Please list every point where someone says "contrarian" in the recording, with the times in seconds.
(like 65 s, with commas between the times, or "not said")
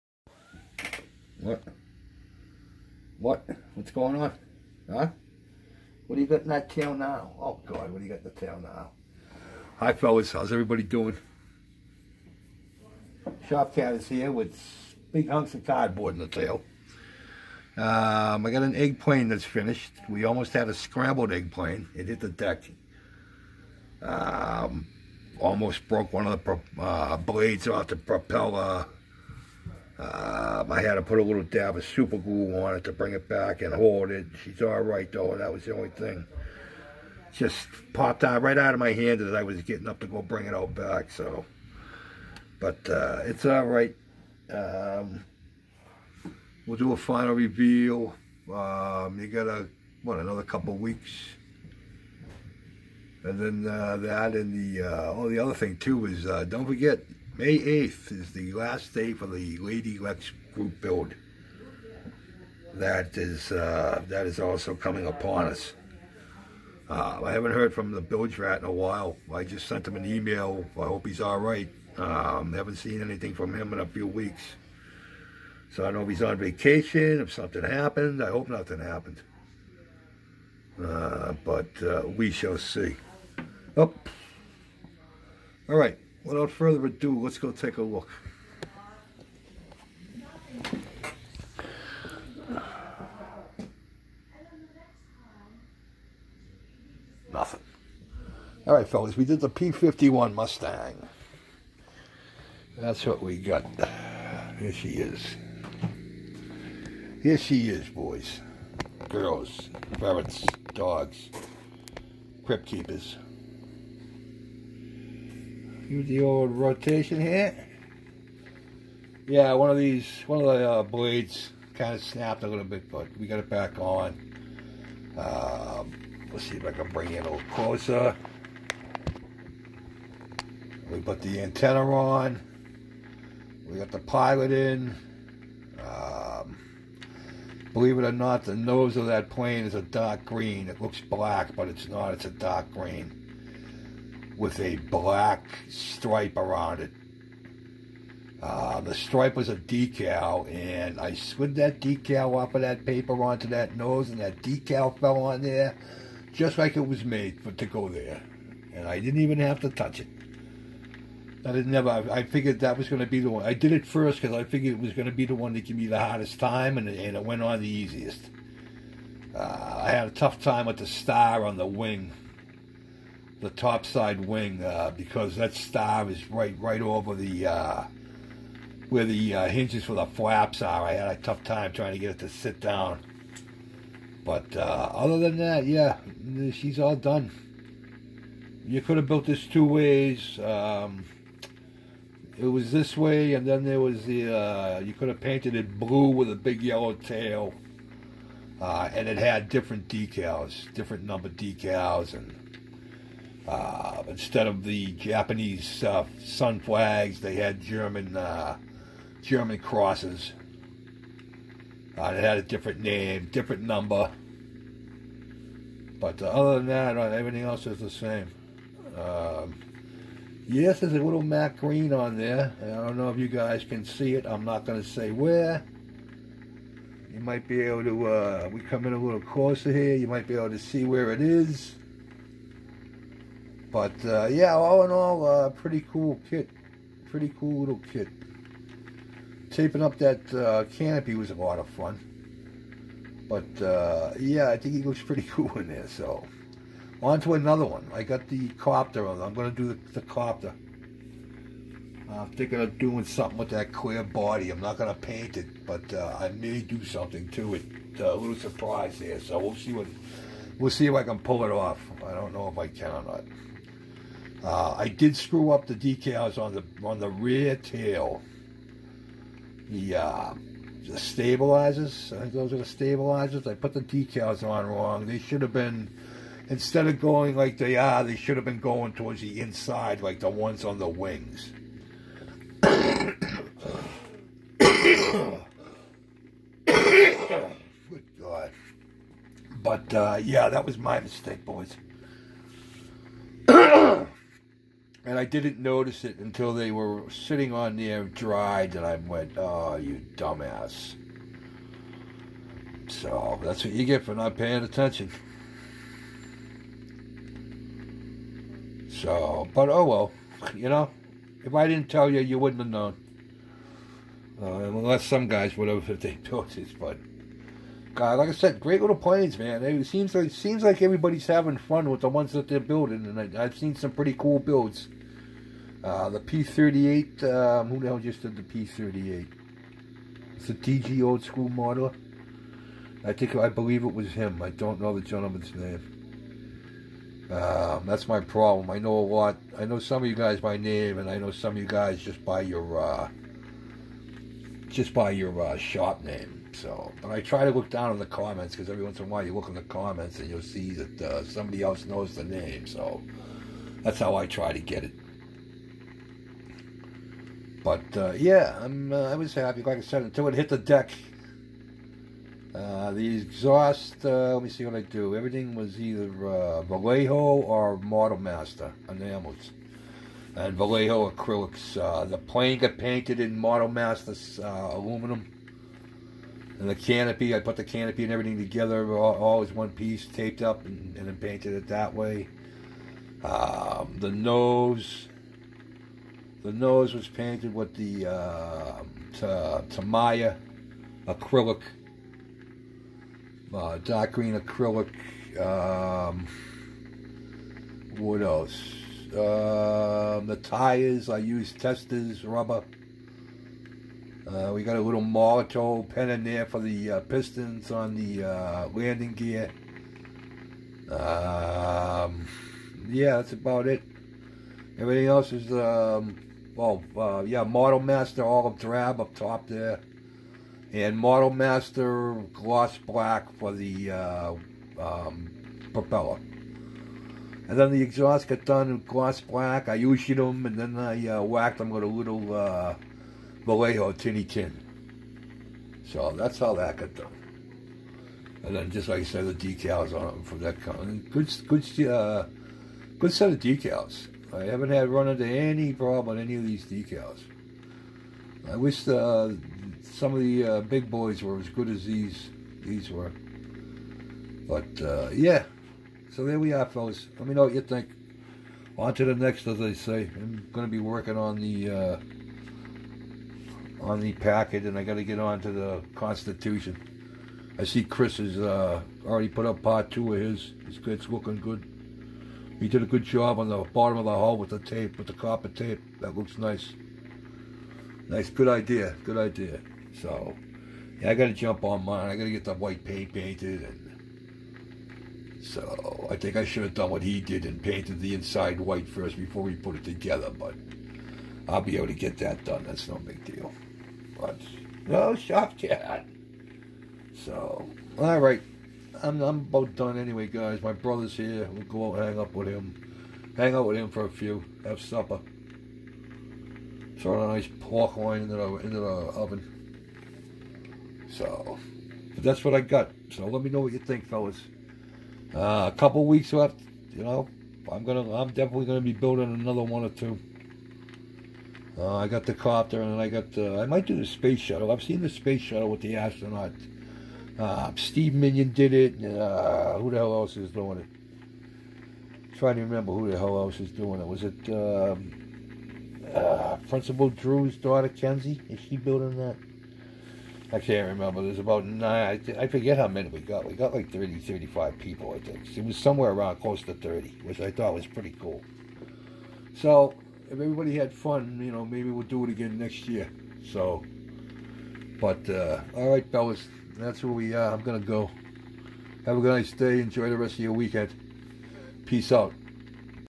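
not said.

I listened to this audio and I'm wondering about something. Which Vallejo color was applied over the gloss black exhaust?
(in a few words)
Tinny Tin.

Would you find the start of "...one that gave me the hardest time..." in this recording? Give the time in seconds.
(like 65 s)
165 s.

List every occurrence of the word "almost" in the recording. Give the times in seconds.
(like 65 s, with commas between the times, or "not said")
20 s, 25 s.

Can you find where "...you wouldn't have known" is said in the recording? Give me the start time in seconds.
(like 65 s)
312 s.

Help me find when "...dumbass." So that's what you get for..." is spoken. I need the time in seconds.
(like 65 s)
300 s.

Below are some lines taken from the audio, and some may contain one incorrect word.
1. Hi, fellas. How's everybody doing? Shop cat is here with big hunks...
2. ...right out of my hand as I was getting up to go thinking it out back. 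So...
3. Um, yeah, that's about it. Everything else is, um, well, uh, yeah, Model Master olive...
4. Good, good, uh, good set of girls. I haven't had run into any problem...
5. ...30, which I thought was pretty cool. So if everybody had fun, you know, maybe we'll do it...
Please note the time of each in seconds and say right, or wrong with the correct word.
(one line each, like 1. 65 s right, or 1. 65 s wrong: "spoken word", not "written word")
1. 9 s right
2. 38 s wrong: "bring", not "thinking"
3. 410 s right
4. 441 s wrong: "decals", not "girls"
5. 546 s right.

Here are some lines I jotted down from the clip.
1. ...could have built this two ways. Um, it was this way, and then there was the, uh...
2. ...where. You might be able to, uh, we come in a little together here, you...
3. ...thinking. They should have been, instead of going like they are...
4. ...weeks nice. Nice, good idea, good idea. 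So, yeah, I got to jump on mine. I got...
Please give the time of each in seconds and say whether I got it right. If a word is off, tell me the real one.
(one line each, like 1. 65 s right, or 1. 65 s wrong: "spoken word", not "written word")
1. 188 s right
2. 225 s wrong: "closer", not "together"
3. 274 s wrong: "wrong", not "thinking"
4. 476 s wrong: "looks", not "weeks".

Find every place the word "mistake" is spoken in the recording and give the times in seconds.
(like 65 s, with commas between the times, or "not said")
290 s.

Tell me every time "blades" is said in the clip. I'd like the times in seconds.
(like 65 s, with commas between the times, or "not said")
27 s, 120 s.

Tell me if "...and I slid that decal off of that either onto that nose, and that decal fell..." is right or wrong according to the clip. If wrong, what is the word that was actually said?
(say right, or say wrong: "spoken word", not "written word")
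wrong: "paper", not "either".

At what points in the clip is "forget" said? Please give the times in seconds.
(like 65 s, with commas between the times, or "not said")
56 s, 542 s.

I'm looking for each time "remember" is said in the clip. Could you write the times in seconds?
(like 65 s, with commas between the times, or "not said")
532 s, 540 s.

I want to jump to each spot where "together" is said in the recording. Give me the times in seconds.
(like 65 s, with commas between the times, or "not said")
378 s, 489 s.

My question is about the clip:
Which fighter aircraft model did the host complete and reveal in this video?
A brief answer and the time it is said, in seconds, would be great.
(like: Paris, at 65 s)
P-51 Mustang, at 99 s.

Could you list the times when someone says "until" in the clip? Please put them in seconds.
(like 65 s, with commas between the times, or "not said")
296 s, 360 s.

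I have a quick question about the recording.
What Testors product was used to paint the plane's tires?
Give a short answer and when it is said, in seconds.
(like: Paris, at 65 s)
Rubber, at 402 s.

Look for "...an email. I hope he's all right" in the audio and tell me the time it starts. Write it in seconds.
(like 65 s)
69 s.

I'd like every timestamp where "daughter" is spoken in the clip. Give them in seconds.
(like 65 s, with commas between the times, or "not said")
537 s.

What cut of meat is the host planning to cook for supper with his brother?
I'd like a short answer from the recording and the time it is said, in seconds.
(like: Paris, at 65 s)
Pork loin, at 507 s.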